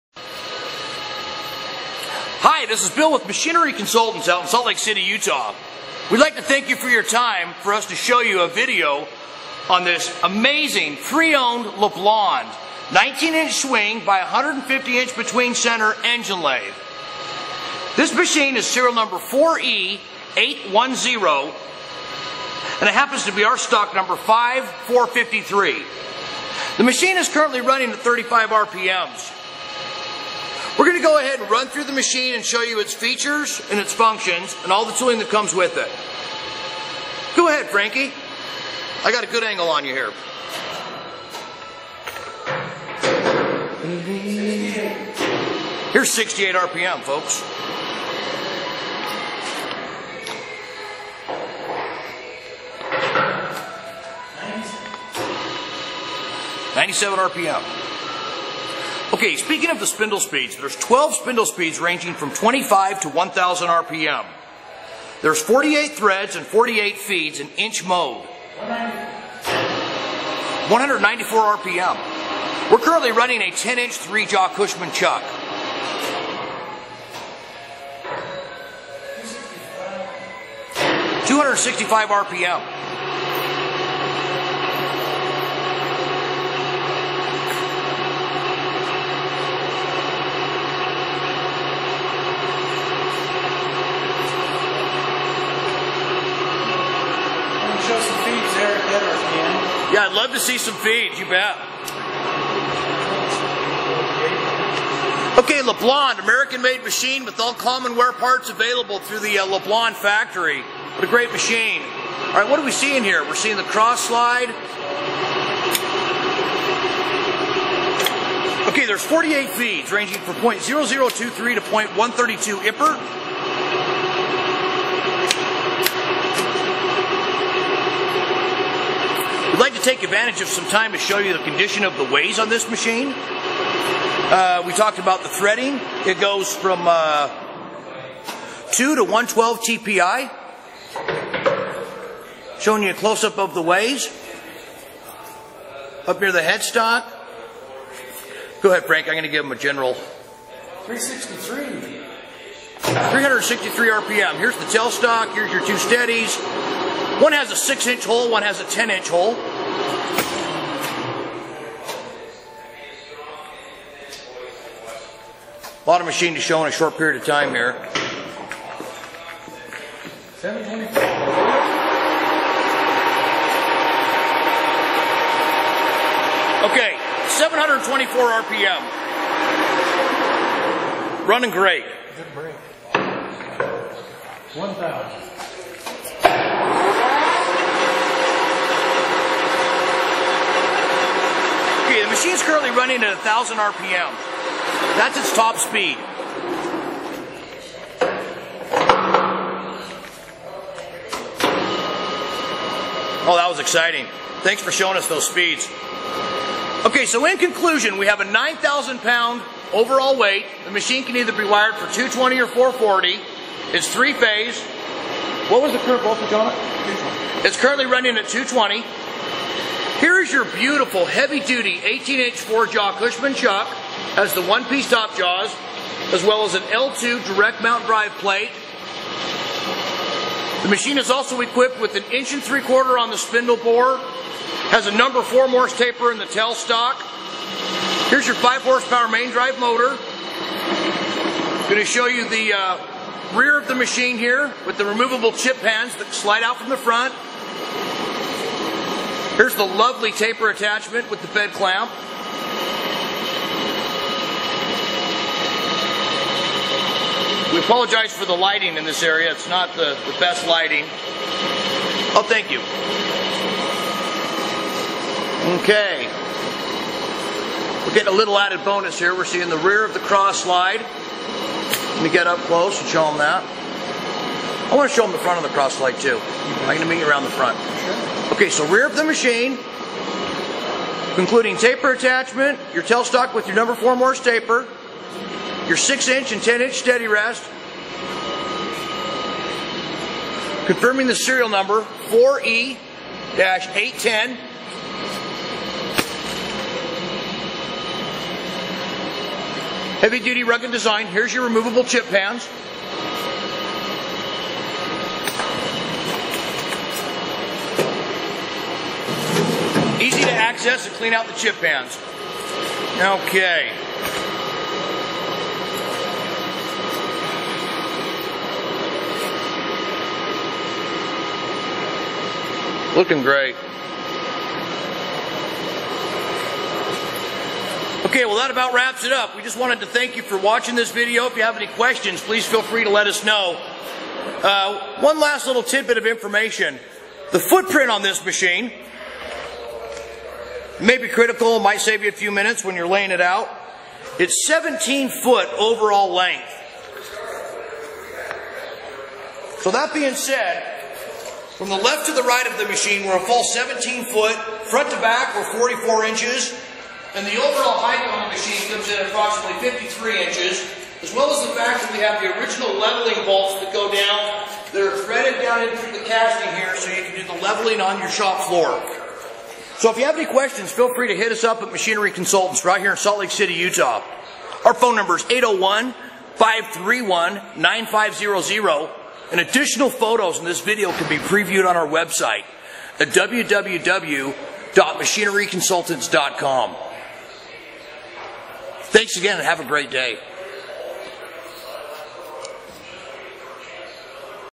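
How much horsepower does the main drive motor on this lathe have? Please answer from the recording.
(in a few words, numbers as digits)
5 horsepower.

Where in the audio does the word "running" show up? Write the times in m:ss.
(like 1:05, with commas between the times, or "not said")
0:27, 1:13, 3:01, 3:12, 3:37.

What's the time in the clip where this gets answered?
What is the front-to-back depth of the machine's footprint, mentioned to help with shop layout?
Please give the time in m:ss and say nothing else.
5:55.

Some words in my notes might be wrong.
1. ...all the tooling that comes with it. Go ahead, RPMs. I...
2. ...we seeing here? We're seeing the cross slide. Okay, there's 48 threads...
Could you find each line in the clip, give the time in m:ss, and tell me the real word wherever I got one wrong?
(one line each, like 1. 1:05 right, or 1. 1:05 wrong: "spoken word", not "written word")
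1. 0:34 wrong: "Frankie", not "RPMs"
2. 1:52 wrong: "feeds", not "threads".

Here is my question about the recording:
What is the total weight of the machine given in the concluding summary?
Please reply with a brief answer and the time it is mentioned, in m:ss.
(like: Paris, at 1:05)
9,000 pounds, at 3:28.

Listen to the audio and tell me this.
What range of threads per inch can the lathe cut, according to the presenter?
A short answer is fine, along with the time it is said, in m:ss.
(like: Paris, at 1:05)
2 to 112 TPI, at 2:18.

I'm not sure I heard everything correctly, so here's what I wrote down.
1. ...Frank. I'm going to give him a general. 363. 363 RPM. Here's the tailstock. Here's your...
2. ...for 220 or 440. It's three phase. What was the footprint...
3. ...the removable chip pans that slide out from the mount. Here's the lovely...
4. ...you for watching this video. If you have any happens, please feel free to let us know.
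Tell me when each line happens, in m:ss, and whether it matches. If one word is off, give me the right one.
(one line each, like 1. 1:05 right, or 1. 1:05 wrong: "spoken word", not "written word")
1. 2:28 right
2. 3:31 wrong: "current", not "footprint"
3. 4:04 wrong: "front", not "mount"
4. 5:30 wrong: "questions", not "happens".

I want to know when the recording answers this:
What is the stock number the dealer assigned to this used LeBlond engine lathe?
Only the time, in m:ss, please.
0:24.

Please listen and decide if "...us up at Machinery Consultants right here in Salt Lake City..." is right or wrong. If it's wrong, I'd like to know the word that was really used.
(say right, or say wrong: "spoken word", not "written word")
right.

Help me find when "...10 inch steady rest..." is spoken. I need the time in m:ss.
4:46.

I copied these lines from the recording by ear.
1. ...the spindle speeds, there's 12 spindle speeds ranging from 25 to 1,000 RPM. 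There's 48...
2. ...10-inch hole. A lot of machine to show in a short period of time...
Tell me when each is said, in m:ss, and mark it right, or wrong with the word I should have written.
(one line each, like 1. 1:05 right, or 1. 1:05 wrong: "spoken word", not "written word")
1. 0:59 right
2. 2:38 right.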